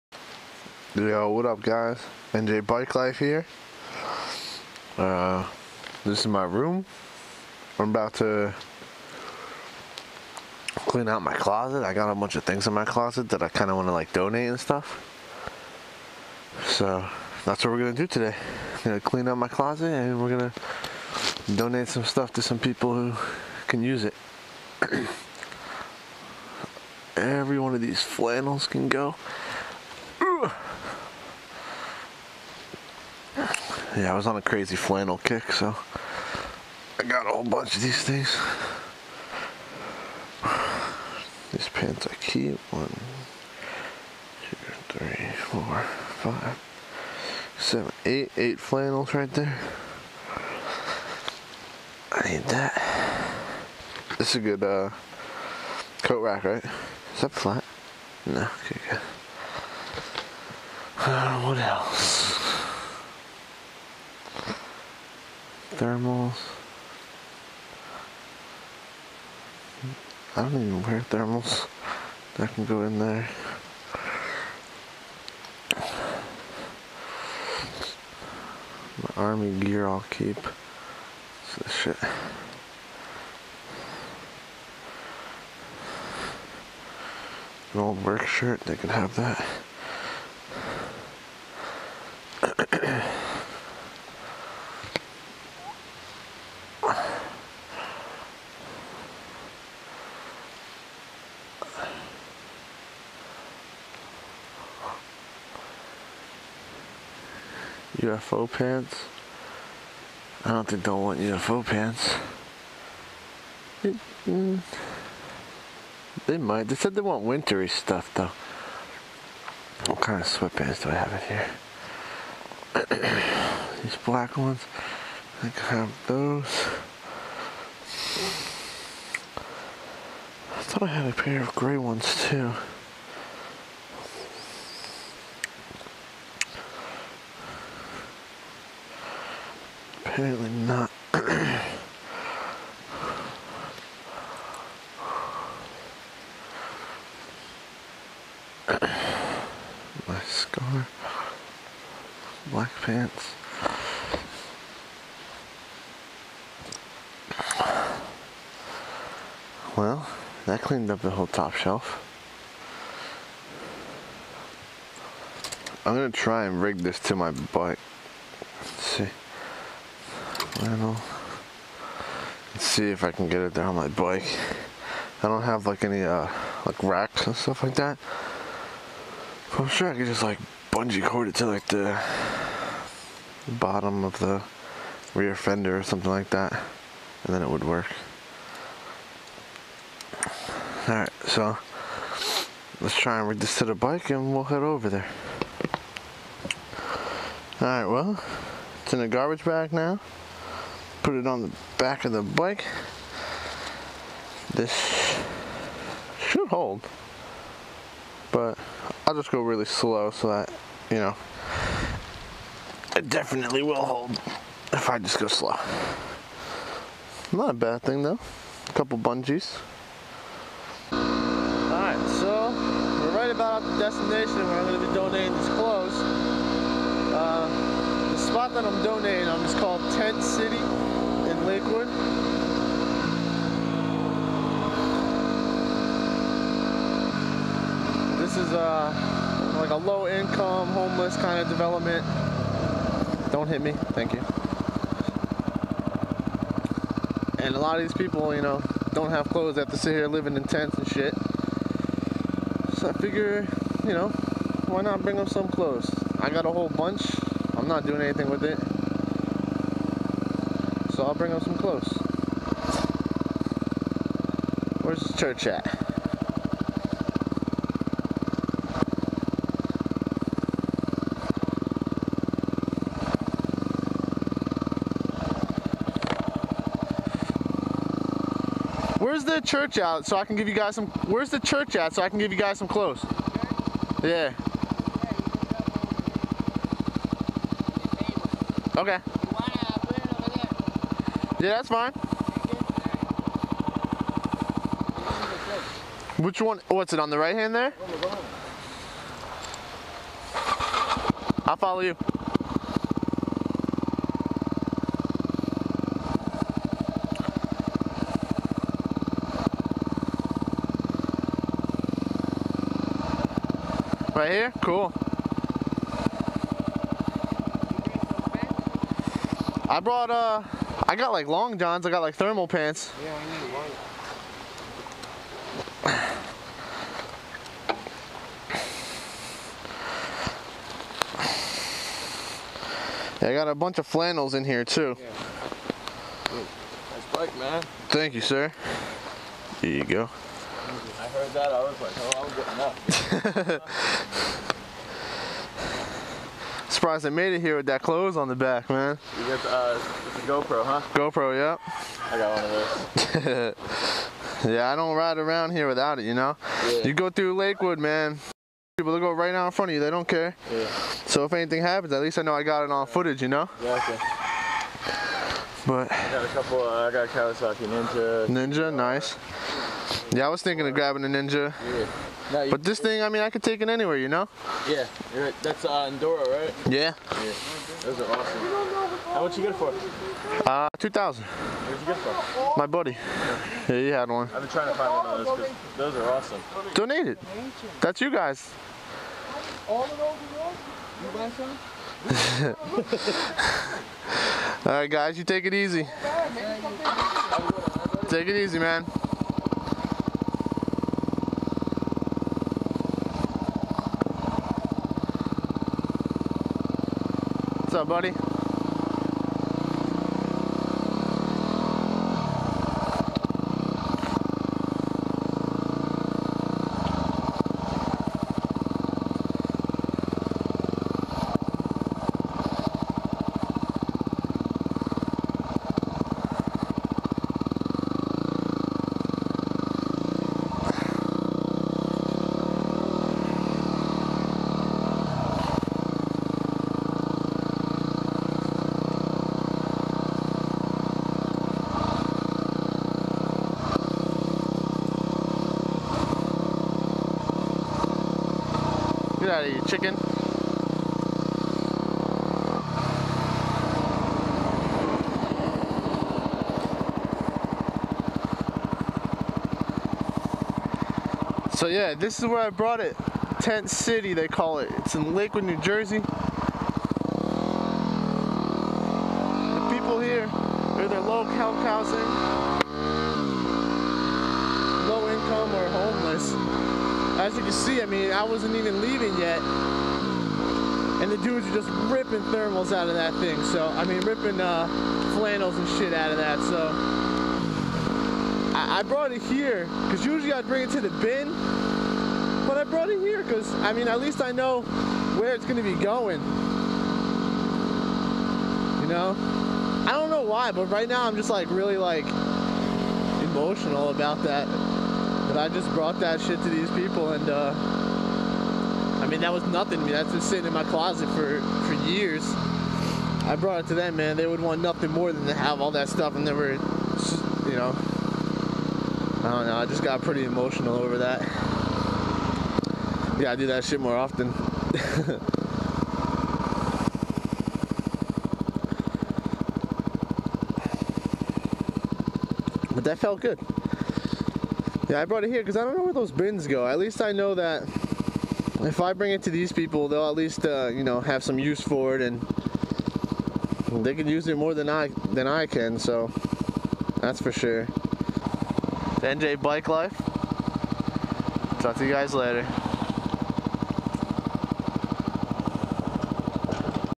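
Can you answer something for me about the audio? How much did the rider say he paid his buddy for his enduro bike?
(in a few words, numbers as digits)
2000.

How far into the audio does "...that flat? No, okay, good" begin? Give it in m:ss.
0:57.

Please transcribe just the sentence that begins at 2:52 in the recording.
Let's see if I can get it there on my bike.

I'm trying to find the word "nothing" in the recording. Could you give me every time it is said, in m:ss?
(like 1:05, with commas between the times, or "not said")
8:29, 8:34.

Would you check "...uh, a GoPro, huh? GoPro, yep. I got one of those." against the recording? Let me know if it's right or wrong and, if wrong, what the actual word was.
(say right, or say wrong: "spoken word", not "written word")
right.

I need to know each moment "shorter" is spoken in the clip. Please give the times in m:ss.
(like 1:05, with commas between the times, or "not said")
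not said.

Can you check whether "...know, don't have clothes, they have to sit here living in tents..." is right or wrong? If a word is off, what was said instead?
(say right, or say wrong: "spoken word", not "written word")
right.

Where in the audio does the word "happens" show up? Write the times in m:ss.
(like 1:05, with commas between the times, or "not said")
6:01.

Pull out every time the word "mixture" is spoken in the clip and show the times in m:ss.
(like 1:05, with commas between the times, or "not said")
not said.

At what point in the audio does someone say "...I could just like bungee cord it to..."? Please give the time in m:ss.
2:59.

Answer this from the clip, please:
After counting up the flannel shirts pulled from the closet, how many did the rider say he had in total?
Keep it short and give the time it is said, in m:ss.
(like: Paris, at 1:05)
8, at 0:48.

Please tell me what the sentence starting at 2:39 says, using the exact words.
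Well, that cleaned up the whole top shelf.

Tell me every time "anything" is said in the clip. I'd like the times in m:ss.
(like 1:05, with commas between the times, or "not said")
4:18, 6:01.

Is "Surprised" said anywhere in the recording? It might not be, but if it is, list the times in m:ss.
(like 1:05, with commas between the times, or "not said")
5:46.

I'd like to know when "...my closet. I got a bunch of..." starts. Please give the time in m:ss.
0:11.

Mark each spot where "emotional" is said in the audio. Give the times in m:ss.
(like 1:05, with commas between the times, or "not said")
8:23, 8:40.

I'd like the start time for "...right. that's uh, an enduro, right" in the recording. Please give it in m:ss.
6:15.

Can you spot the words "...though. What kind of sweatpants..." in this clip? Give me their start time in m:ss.
1:58.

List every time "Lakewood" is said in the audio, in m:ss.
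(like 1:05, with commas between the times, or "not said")
3:51, 5:57, 7:45.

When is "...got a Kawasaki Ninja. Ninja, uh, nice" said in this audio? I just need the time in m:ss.
6:06.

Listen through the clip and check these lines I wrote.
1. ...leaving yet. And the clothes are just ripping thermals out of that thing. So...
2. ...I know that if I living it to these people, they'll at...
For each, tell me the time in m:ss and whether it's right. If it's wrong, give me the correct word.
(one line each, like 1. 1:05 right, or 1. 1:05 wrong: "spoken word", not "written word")
1. 7:58 wrong: "dudes", not "clothes"
2. 8:57 wrong: "bring", not "living".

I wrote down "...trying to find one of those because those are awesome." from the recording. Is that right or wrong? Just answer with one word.
right.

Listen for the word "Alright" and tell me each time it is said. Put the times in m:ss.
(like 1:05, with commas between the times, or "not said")
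3:10, 3:17, 3:40.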